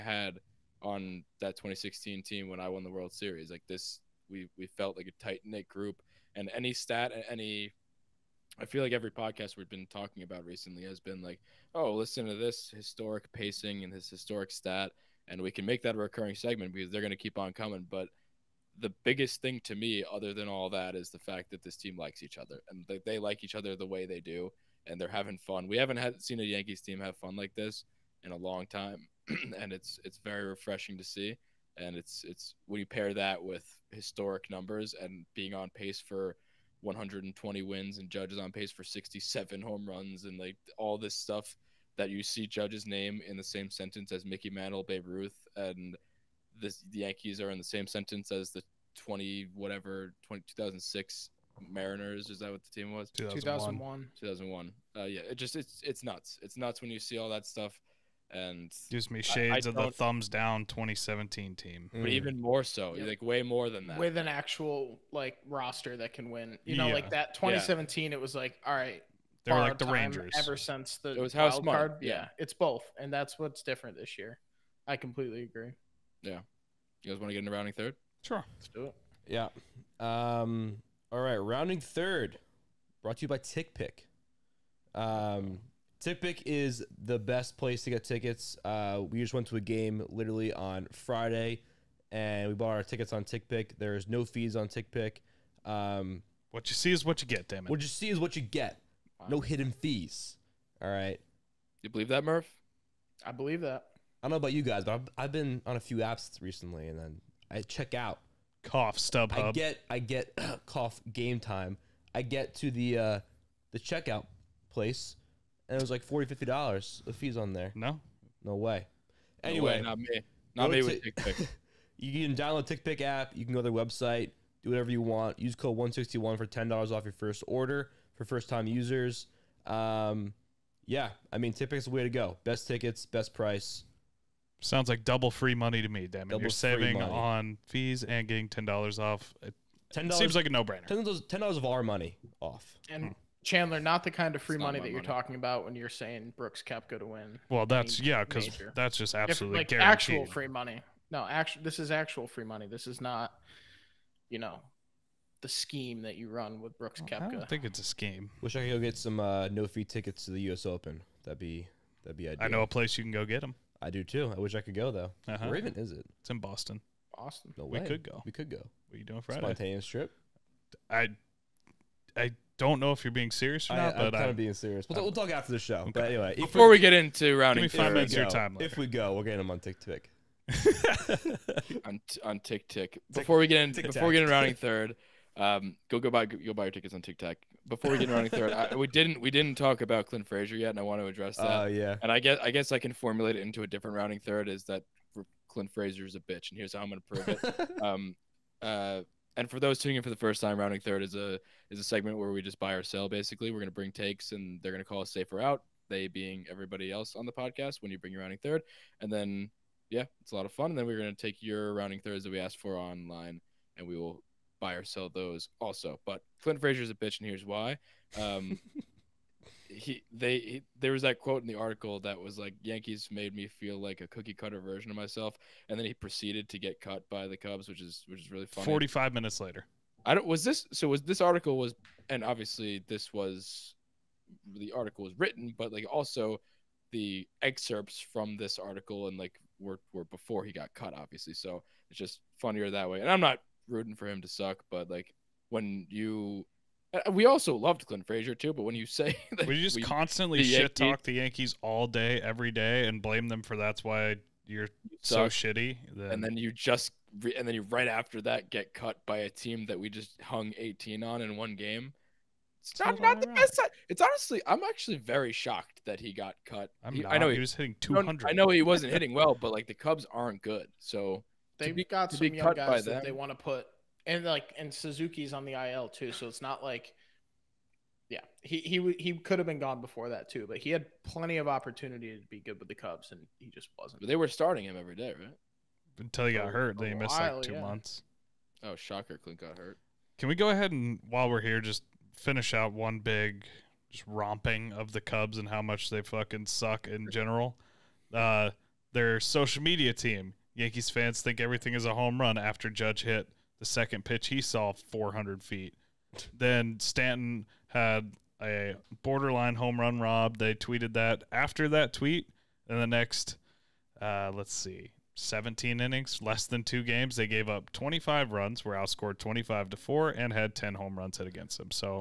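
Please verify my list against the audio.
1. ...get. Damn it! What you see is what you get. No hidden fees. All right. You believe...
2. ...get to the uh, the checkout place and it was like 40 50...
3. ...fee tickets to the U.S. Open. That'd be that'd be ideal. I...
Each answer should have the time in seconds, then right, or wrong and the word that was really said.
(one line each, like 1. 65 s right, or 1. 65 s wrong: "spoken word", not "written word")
1. 97 s right
2. 112 s right
3. 159 s right.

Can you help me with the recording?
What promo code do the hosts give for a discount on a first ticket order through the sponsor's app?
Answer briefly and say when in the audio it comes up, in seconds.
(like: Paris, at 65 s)
161, at 125 s.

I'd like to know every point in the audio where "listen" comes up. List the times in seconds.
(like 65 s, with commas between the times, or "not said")
11 s.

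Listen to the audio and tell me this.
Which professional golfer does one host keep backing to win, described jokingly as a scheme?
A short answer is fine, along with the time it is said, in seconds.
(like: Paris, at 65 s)
Brooks Koepka, at 146 s.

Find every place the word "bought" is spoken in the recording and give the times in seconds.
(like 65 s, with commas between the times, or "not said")
92 s.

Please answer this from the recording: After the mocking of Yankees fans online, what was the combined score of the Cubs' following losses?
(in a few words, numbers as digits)
25 to 4.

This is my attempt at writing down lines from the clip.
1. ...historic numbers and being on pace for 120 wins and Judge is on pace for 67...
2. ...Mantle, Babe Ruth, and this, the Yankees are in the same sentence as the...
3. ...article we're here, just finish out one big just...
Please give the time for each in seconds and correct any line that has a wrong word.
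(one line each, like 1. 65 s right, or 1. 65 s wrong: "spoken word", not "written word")
1. 33 s right
2. 44 s right
3. 291 s wrong: "while", not "article".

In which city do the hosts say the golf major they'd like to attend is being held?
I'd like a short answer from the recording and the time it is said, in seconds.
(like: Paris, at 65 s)
Boston, at 166 s.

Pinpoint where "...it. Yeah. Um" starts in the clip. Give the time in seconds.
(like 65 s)
78 s.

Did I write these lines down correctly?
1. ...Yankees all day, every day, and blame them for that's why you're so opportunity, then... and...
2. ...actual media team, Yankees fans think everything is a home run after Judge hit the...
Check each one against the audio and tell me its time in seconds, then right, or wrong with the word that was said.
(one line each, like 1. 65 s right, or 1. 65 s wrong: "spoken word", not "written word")
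1. 251 s wrong: "shitty", not "opportunity"
2. 299 s wrong: "social", not "actual".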